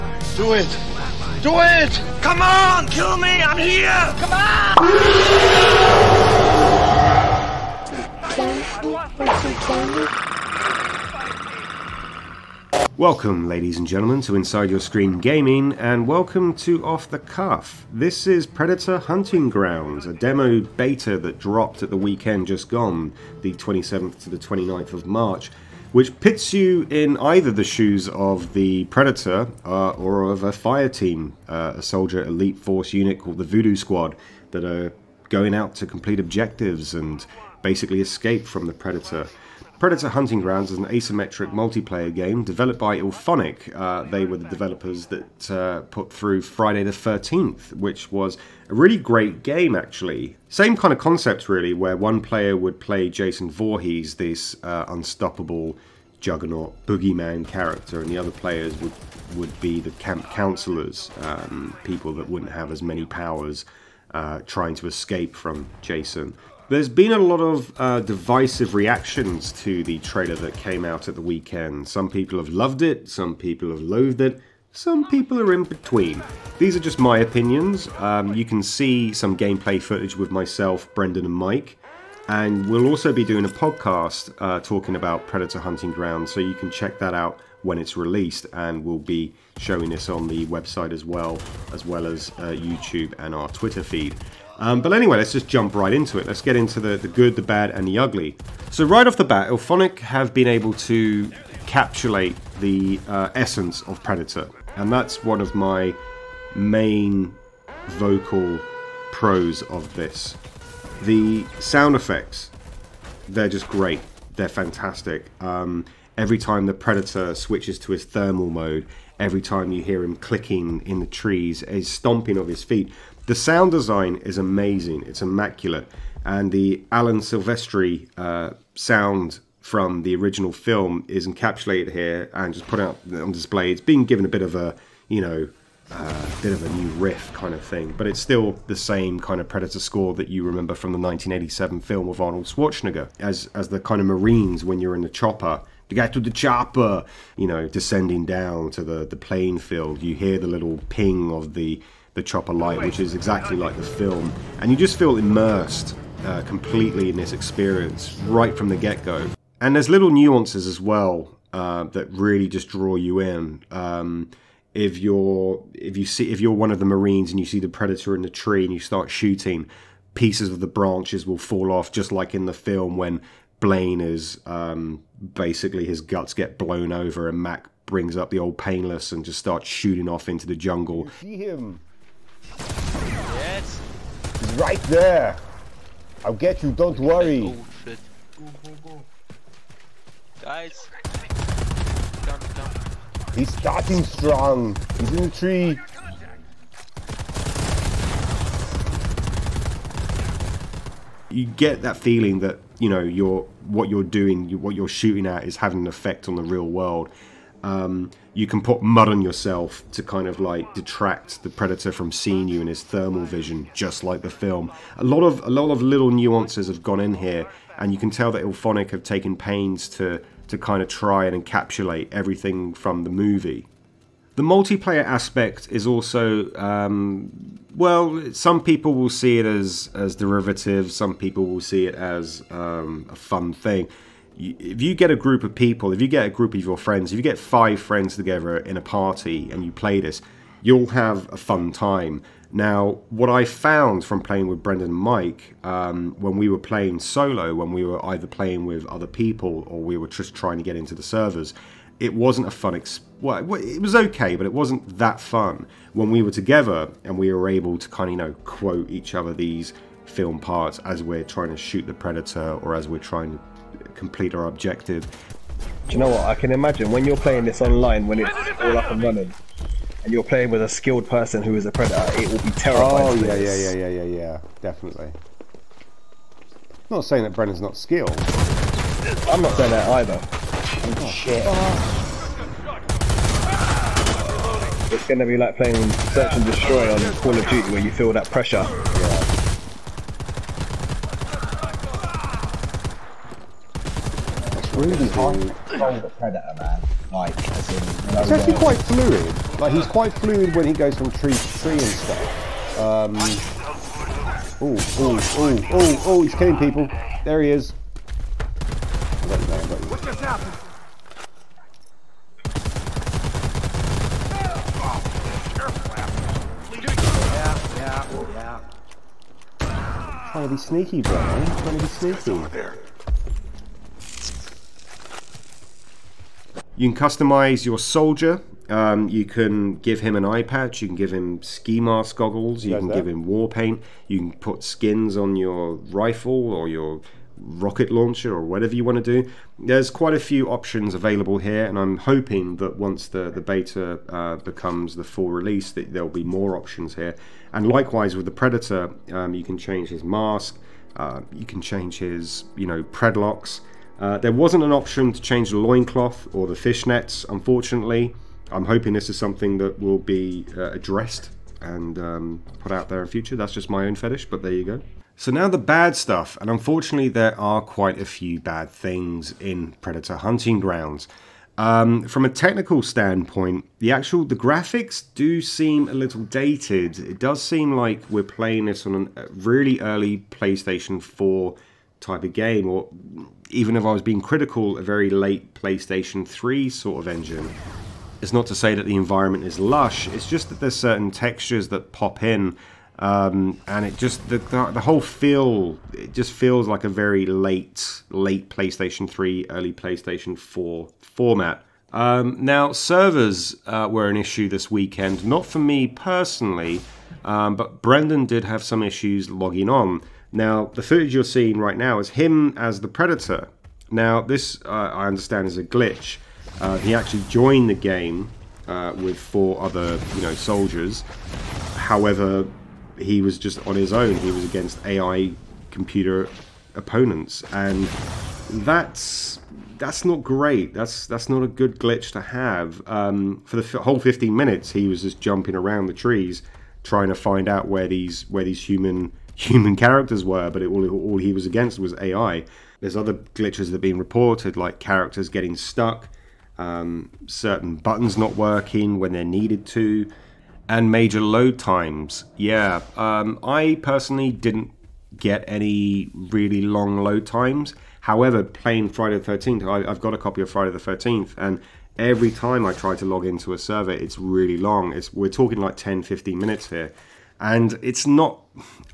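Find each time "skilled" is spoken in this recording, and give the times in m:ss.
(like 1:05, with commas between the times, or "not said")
4:30, 4:37.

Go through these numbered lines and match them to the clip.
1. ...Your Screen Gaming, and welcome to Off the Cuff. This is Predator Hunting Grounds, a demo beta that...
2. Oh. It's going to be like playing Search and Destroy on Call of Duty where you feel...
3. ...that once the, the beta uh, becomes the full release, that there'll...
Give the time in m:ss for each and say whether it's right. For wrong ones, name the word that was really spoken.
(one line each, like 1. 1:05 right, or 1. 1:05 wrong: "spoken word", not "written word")
1. 0:14 right
2. 4:41 right
3. 5:42 right.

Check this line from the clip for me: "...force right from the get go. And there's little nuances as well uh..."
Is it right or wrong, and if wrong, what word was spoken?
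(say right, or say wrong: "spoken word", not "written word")
wrong: "experience", not "force".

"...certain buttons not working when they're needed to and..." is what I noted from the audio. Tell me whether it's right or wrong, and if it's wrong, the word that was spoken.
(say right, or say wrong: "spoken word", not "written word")
right.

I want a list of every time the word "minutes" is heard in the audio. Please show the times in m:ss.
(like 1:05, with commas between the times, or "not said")
7:14, 7:46.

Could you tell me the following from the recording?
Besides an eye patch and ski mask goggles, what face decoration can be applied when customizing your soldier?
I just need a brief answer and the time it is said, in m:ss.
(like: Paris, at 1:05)
war paint, at 5:33.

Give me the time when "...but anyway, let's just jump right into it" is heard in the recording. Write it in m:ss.
1:34.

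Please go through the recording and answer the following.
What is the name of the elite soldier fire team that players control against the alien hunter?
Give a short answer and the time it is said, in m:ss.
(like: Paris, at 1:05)
Voodoo Squad, at 0:33.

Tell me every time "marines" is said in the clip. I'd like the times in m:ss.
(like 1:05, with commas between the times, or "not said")
2:24, 2:46.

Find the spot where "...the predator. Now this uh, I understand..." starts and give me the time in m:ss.
6:52.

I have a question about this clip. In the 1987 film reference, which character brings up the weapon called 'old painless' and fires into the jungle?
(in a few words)
Mac.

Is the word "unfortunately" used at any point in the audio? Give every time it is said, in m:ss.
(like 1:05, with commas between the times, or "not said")
5:57, 6:06.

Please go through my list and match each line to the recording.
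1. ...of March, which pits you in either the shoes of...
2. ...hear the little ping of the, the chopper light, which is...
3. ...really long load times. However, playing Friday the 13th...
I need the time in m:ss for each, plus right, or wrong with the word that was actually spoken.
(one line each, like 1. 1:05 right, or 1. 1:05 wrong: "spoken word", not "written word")
1. 0:24 right
2. 2:30 right
3. 7:36 right.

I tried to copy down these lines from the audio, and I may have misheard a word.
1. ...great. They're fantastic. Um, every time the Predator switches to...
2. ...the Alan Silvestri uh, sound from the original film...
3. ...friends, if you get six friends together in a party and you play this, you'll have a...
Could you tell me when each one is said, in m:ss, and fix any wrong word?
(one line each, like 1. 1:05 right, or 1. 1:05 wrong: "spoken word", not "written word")
1. 1:53 right
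2. 2:06 right
3. 3:56 wrong: "five", not "six".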